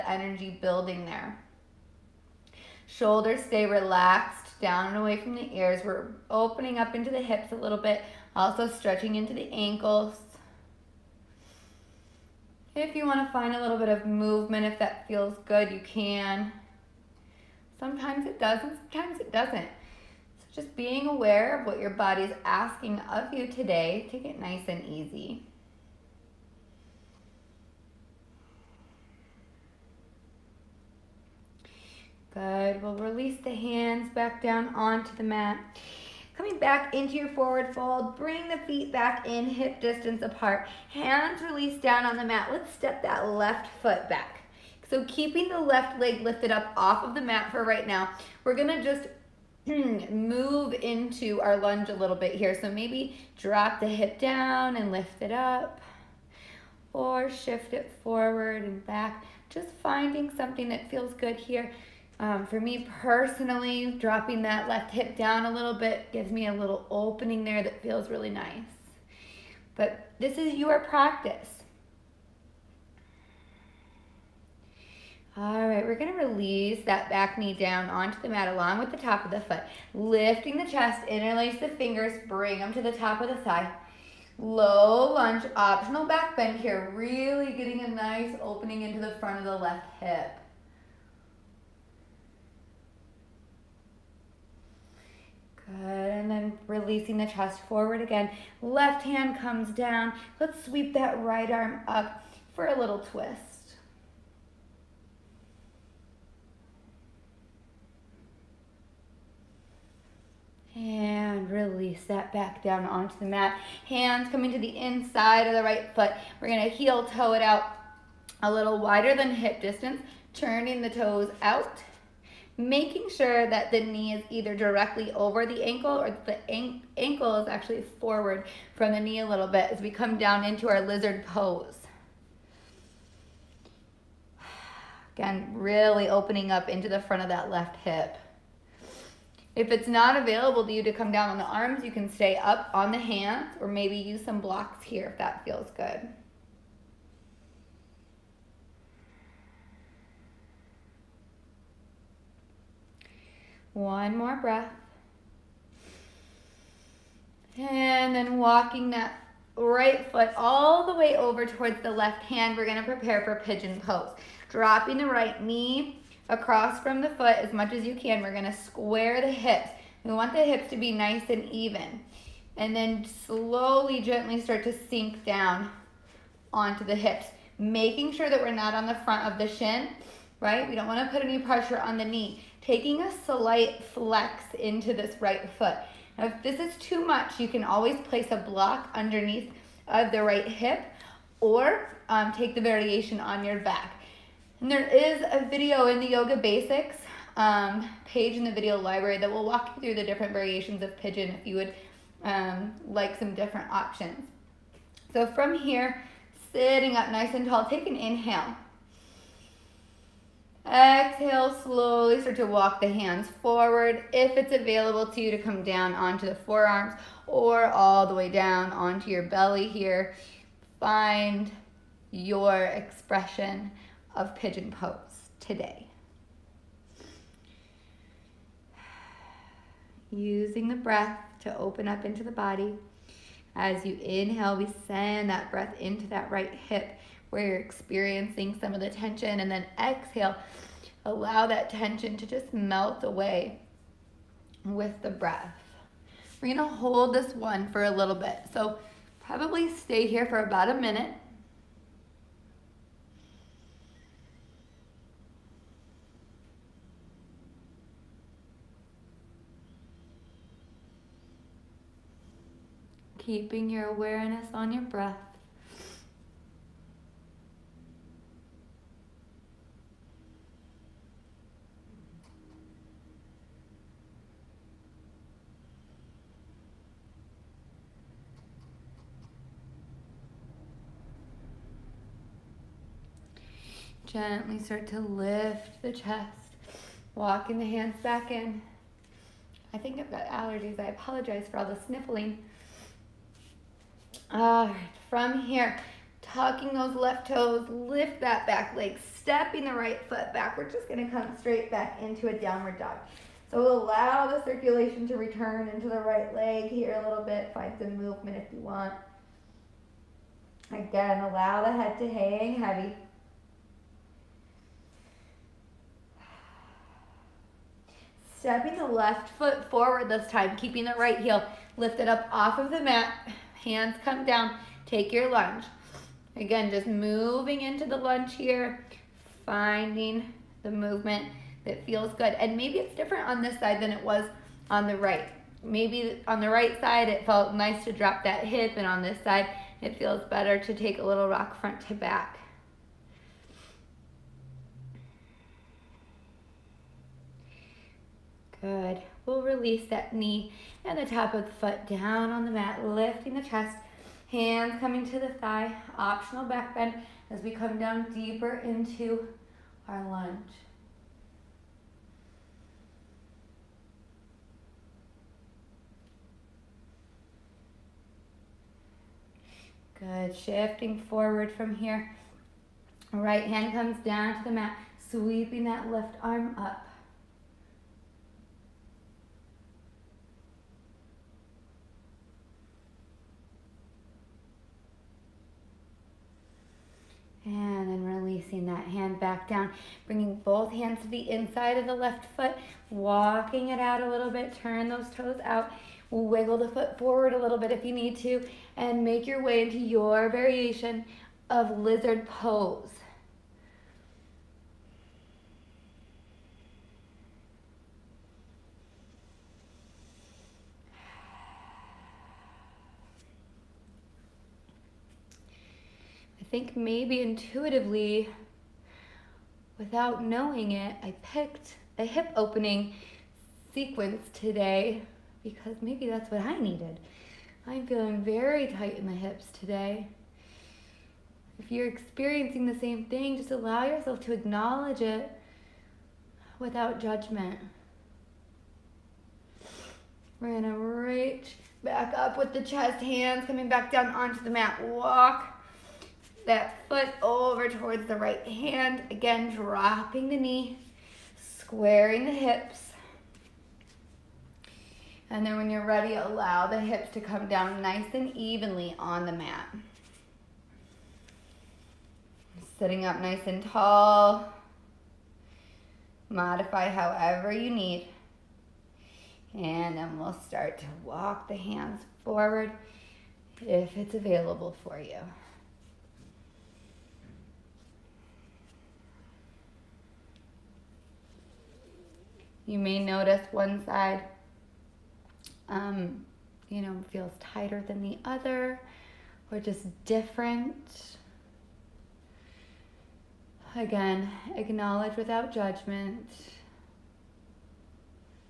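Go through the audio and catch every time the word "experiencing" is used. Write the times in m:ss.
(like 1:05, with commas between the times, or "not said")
3:57, 7:11.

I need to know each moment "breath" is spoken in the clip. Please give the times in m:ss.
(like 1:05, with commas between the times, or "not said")
2:34, 3:50, 3:55, 4:05, 4:24.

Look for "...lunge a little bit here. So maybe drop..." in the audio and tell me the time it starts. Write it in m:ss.
0:51.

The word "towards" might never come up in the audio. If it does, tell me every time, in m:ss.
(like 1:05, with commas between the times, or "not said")
2:41, 7:27.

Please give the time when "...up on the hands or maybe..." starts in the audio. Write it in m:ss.
2:22.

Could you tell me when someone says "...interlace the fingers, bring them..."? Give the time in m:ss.
1:21.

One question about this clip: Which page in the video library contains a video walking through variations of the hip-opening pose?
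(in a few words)
Yoga Basics.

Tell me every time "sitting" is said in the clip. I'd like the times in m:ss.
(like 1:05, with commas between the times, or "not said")
3:26, 7:42.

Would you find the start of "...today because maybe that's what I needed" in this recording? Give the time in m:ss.
7:04.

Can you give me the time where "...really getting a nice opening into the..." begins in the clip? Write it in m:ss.
1:26.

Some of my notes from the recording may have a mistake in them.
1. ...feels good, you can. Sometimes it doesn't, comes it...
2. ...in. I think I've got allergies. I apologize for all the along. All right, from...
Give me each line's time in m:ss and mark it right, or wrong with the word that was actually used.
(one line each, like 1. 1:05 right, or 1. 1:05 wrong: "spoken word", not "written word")
1. 0:15 wrong: "sometimes", not "comes"
2. 4:48 wrong: "sniffling", not "along".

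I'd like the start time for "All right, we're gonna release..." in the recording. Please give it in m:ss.
1:15.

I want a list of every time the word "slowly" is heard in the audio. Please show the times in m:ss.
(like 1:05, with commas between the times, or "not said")
2:53, 3:31.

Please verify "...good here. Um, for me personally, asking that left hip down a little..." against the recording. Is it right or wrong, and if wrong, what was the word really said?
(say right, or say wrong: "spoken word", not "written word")
wrong: "dropping", not "asking".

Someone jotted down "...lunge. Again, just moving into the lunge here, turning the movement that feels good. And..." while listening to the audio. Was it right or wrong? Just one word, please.
wrong.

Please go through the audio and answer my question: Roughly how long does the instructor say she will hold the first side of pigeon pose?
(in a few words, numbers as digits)
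About a minute.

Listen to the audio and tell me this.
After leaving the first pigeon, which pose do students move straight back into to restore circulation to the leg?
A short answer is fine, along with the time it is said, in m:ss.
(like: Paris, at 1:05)
Downward dog, at 5:02.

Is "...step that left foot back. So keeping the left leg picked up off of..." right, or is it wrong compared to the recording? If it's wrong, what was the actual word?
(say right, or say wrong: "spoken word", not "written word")
wrong: "lifted", not "picked".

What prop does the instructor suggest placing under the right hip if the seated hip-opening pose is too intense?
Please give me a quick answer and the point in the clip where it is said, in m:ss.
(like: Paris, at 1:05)
A block, at 3:08.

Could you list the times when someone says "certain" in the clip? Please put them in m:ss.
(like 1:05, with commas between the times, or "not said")
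not said.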